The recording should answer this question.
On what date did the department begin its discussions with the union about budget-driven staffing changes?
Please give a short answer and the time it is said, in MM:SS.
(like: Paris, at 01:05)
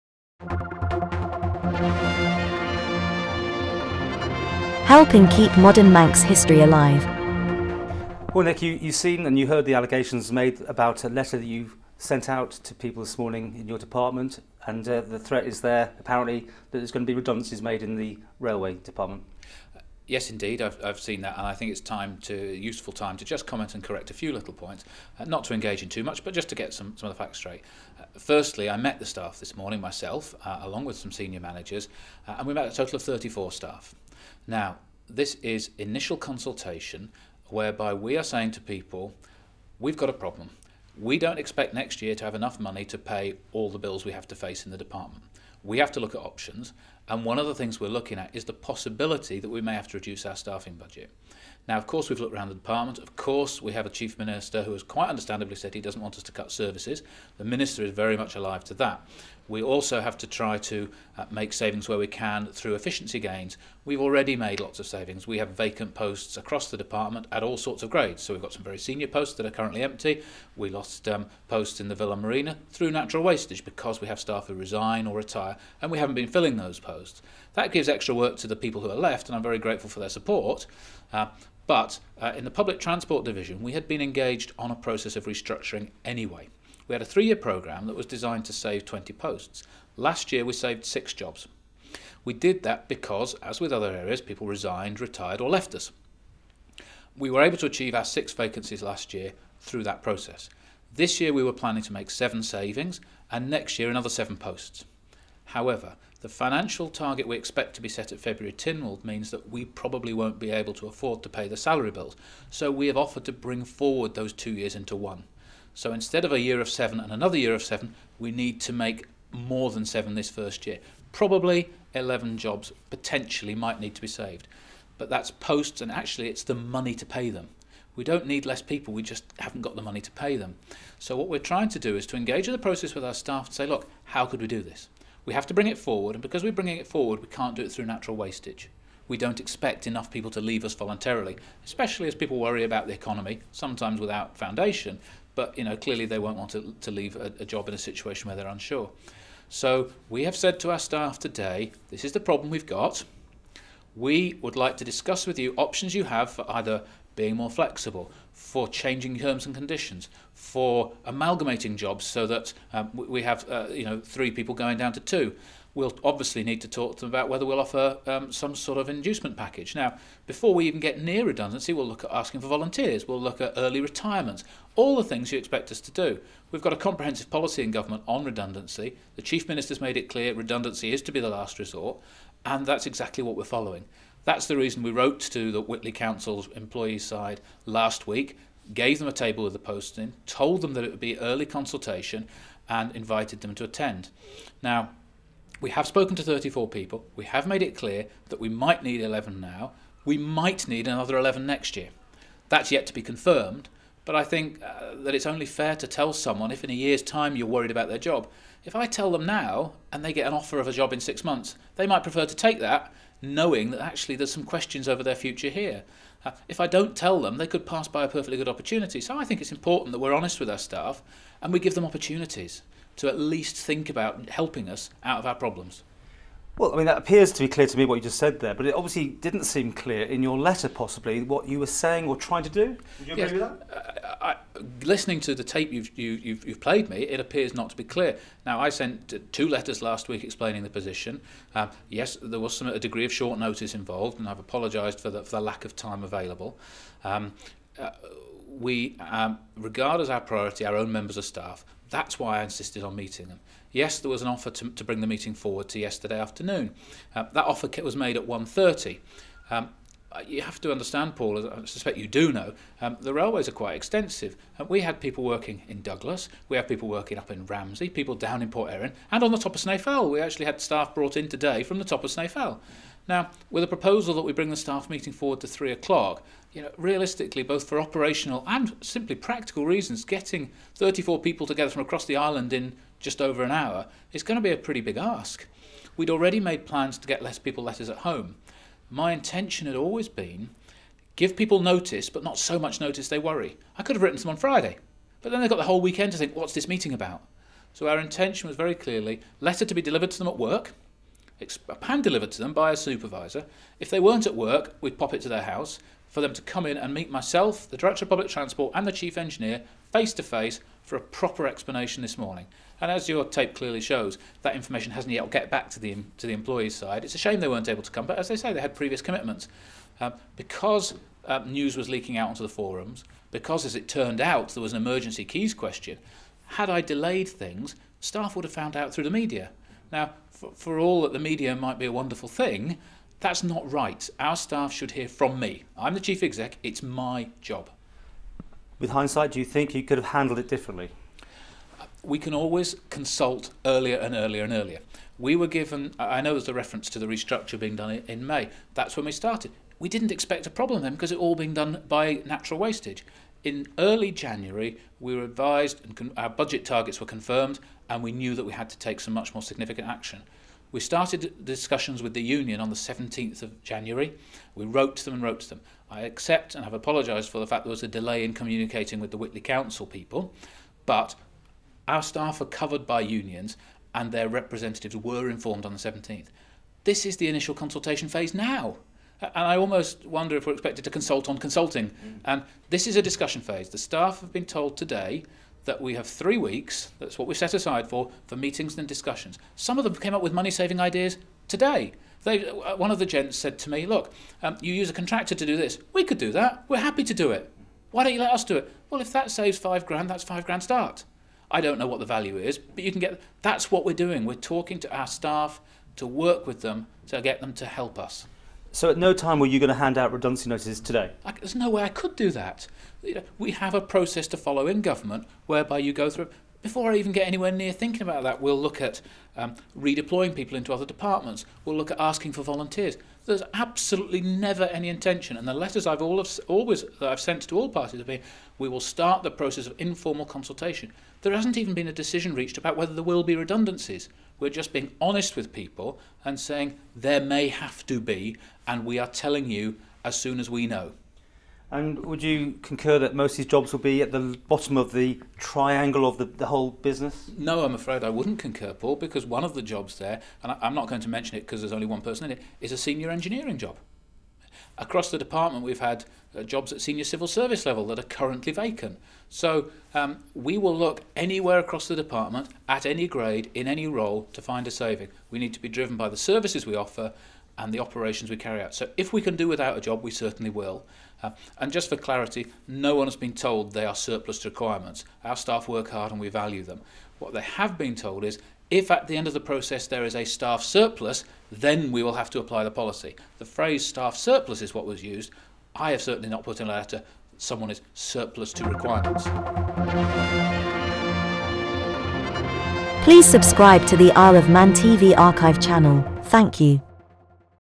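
17 January, at 06:02.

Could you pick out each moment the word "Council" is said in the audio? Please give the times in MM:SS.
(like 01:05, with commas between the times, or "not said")
03:05, 06:09.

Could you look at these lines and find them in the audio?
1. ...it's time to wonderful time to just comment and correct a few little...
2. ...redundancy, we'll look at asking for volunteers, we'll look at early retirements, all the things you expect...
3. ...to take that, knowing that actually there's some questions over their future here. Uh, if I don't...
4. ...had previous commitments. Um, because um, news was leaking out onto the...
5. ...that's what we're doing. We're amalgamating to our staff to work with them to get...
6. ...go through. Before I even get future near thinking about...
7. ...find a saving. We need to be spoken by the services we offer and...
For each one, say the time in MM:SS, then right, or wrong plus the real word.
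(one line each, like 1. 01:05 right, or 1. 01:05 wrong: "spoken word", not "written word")
1. 00:21 wrong: "useful", not "wonderful"
2. 02:51 right
3. 03:32 right
4. 05:18 right
5. 06:43 wrong: "talking", not "amalgamating"
6. 06:55 wrong: "anywhere", not "future"
7. 07:44 wrong: "driven", not "spoken".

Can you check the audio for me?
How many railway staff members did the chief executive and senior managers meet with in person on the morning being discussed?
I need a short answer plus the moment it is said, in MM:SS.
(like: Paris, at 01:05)
34, at 00:32.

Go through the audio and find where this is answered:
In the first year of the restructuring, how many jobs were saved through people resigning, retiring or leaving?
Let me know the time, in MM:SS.
01:30.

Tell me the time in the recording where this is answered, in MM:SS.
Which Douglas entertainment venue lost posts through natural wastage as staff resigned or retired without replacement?
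01:11.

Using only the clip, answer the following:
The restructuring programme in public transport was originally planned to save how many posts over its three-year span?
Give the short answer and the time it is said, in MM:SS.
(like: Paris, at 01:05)
20, at 01:28.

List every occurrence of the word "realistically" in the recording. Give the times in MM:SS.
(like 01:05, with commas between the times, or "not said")
04:36.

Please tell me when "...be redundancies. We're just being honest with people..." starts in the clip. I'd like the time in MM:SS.
07:13.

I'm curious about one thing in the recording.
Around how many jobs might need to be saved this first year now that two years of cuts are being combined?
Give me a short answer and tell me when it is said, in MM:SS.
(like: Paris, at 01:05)
11, at 02:01.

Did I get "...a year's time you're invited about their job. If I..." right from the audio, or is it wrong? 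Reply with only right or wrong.
wrong.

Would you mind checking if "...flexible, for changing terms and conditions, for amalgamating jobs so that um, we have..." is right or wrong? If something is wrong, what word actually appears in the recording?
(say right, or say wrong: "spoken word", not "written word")
right.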